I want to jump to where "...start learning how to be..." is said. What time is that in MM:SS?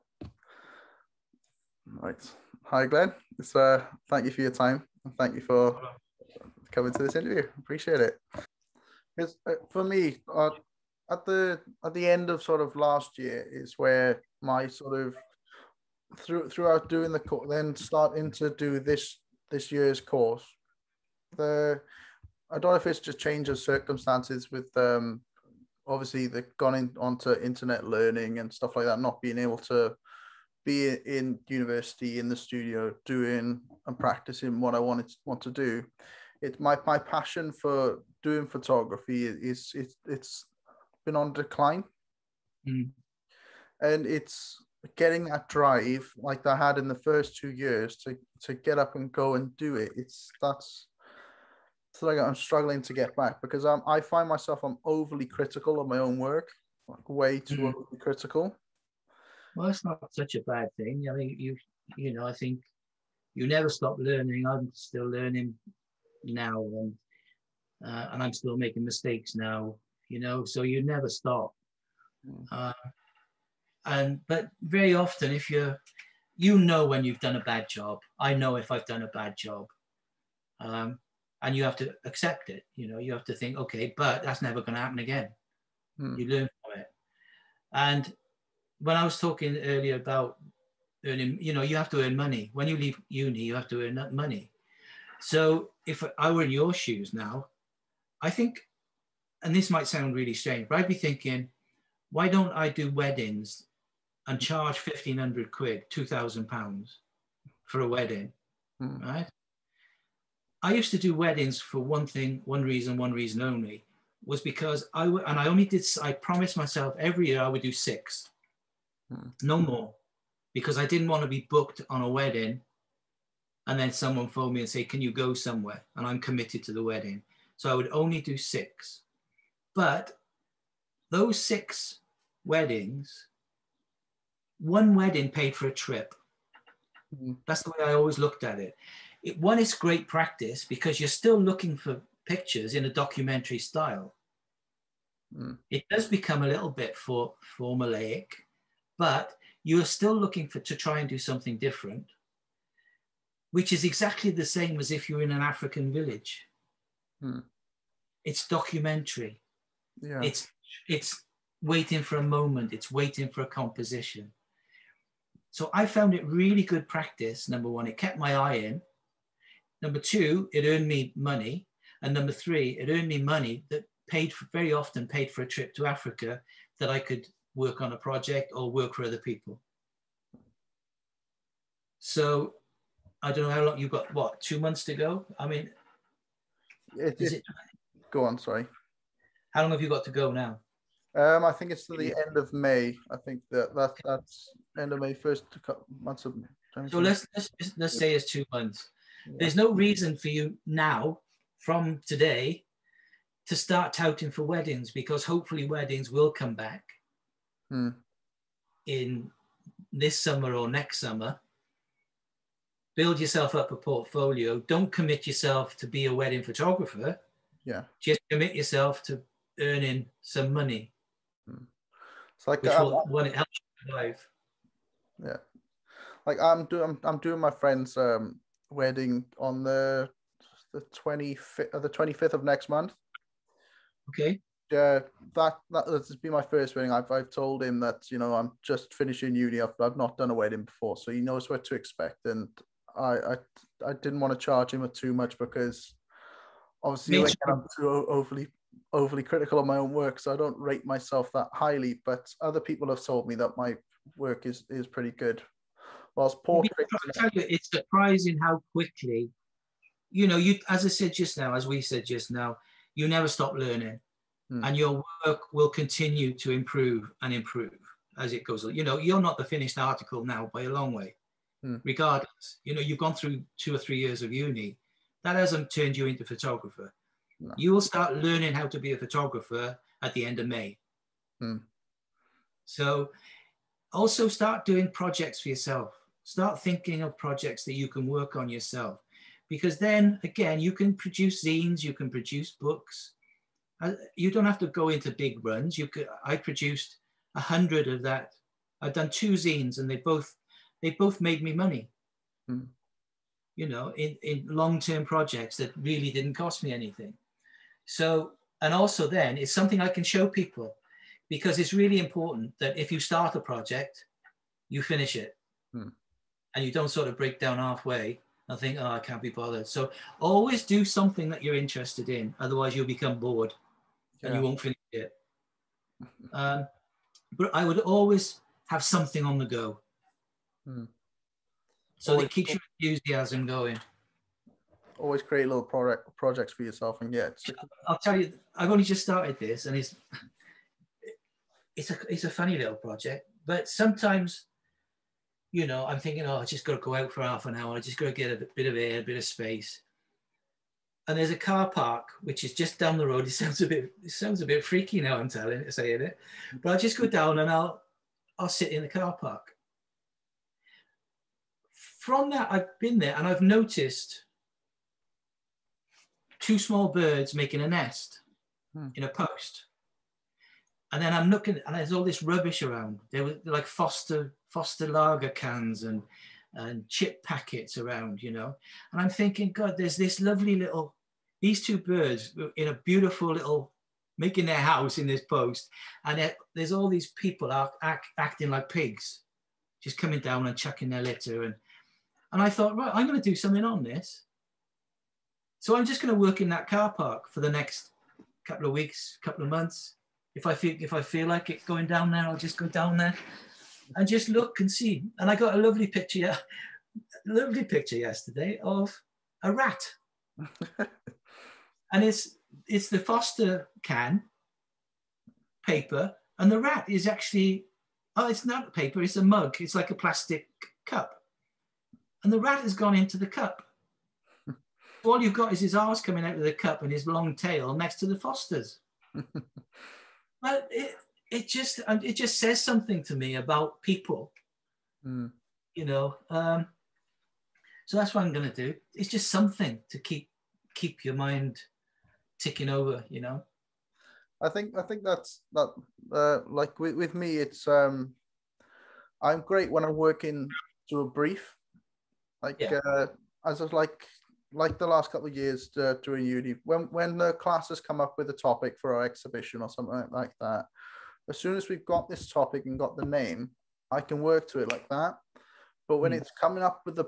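04:37.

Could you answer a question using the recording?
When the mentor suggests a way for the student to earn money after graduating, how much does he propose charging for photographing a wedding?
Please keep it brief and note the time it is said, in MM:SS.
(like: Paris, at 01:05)
£2000, at 01:45.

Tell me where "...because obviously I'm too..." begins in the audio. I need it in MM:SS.
04:05.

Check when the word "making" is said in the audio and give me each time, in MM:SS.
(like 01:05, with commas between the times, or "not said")
01:08, 06:07, 06:24.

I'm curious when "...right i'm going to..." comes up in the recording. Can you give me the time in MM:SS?
06:32.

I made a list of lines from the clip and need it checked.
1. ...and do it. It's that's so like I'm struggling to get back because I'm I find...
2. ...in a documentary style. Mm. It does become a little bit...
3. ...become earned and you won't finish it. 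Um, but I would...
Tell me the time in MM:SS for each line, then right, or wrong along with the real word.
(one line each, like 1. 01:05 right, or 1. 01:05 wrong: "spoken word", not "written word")
1. 00:49 right
2. 02:22 right
3. 05:22 wrong: "bored", not "earned".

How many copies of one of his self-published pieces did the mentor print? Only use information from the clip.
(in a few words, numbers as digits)
100.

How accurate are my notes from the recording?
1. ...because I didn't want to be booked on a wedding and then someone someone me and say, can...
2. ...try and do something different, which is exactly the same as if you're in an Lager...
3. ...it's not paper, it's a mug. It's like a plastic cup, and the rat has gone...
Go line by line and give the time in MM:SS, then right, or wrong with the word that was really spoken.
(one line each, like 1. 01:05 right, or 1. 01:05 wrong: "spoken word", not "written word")
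1. 02:00 wrong: "phone", not "someone"
2. 02:30 wrong: "African", not "Lager"
3. 06:58 right.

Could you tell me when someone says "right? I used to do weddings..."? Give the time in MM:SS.
01:49.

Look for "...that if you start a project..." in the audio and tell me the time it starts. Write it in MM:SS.
05:12.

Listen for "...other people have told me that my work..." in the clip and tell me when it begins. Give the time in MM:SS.
04:12.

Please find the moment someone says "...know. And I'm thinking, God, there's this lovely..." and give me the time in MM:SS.
06:18.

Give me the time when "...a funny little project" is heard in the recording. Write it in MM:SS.
05:42.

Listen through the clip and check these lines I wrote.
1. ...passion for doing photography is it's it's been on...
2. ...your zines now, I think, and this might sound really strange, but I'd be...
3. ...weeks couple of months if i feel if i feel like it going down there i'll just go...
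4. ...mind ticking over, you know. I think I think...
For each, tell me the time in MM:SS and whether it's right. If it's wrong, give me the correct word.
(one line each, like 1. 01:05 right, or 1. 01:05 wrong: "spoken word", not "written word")
1. 00:36 right
2. 01:36 wrong: "shoes", not "zines"
3. 06:38 right
4. 07:21 right.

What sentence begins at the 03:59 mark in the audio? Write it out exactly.
I've, I've not done a wedding before, so he knows what to expect.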